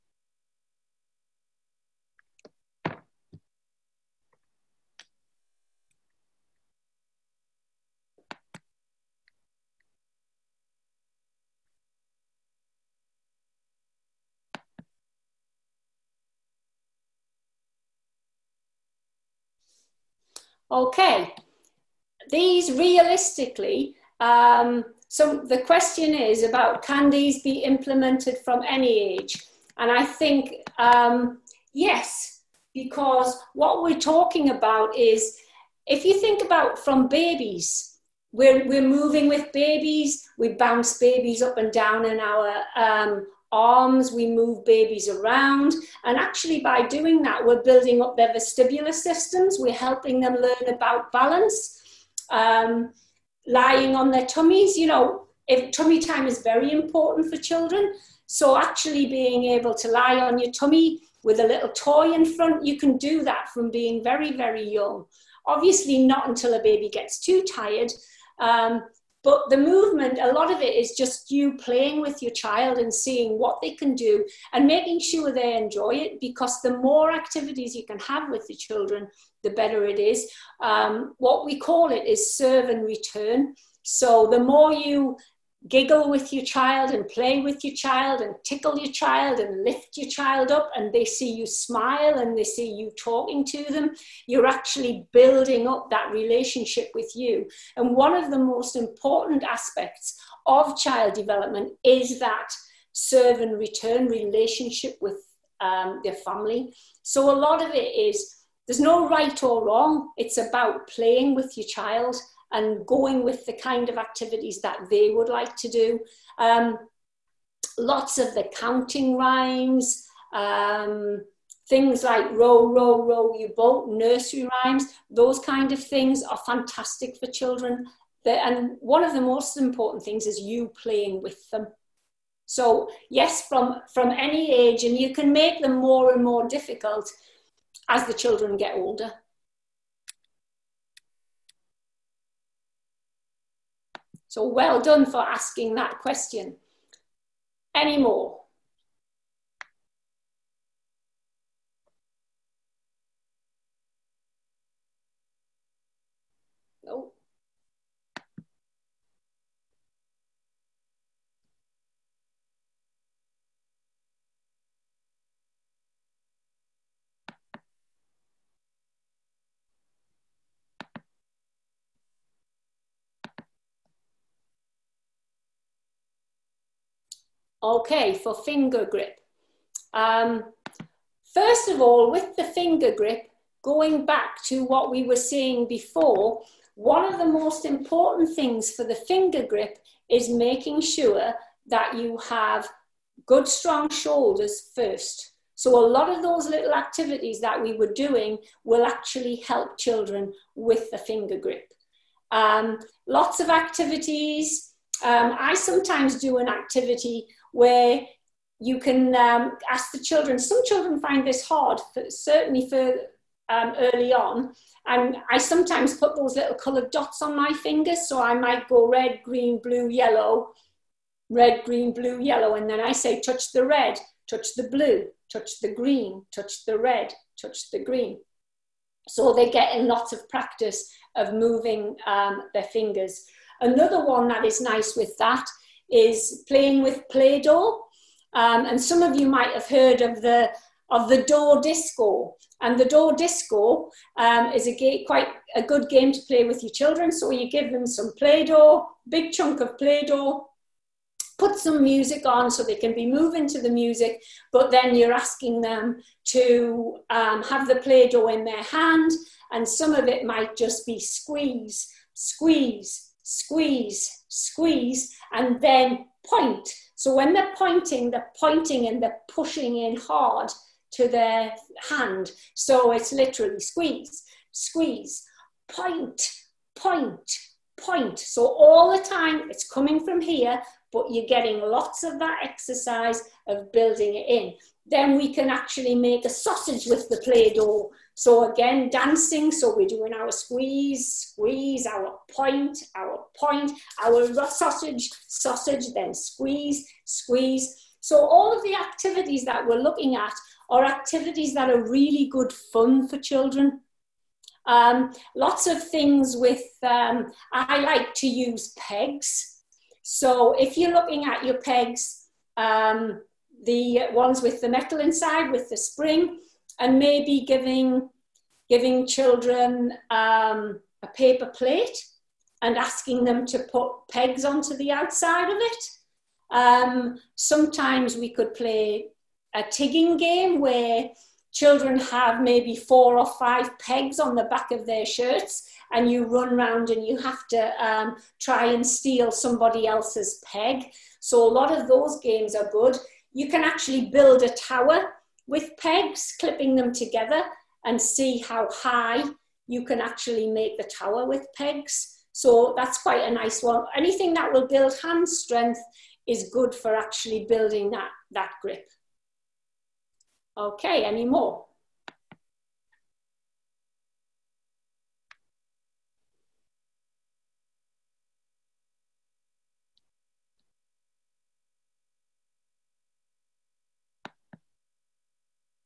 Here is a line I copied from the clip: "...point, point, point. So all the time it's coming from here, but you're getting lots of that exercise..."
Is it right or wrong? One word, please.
right.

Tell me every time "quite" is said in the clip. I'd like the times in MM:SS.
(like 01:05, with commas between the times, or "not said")
04:05, 05:53.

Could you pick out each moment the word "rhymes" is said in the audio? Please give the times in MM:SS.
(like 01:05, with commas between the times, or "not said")
01:59, 02:04.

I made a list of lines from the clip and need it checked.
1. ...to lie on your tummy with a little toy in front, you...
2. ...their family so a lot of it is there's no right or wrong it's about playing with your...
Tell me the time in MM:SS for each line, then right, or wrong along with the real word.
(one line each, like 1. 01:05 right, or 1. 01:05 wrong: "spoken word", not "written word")
1. 00:59 right
2. 01:46 right.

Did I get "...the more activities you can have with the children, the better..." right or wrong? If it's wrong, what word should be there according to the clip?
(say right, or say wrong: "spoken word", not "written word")
right.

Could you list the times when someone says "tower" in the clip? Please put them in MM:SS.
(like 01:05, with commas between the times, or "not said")
05:44, 05:50.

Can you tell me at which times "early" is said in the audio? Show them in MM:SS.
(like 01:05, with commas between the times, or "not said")
03:33.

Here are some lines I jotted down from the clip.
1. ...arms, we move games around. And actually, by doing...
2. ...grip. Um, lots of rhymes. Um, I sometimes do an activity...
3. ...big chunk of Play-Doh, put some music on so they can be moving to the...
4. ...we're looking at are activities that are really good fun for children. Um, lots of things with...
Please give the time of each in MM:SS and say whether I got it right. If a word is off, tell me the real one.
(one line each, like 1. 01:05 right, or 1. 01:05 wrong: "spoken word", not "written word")
1. 00:43 wrong: "babies", not "games"
2. 03:21 wrong: "activities", not "rhymes"
3. 04:09 right
4. 04:59 right.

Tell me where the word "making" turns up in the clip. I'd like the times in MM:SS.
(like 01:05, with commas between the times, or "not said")
01:14, 03:10.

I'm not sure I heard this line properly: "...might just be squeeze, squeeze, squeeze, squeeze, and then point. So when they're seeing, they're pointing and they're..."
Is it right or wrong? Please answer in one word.
wrong.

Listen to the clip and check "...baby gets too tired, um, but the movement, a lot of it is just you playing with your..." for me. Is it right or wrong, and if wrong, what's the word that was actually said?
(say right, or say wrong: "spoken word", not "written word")
right.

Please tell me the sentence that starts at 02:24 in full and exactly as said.
So well done for asking that question.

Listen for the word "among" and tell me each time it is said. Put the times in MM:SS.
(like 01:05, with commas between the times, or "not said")
not said.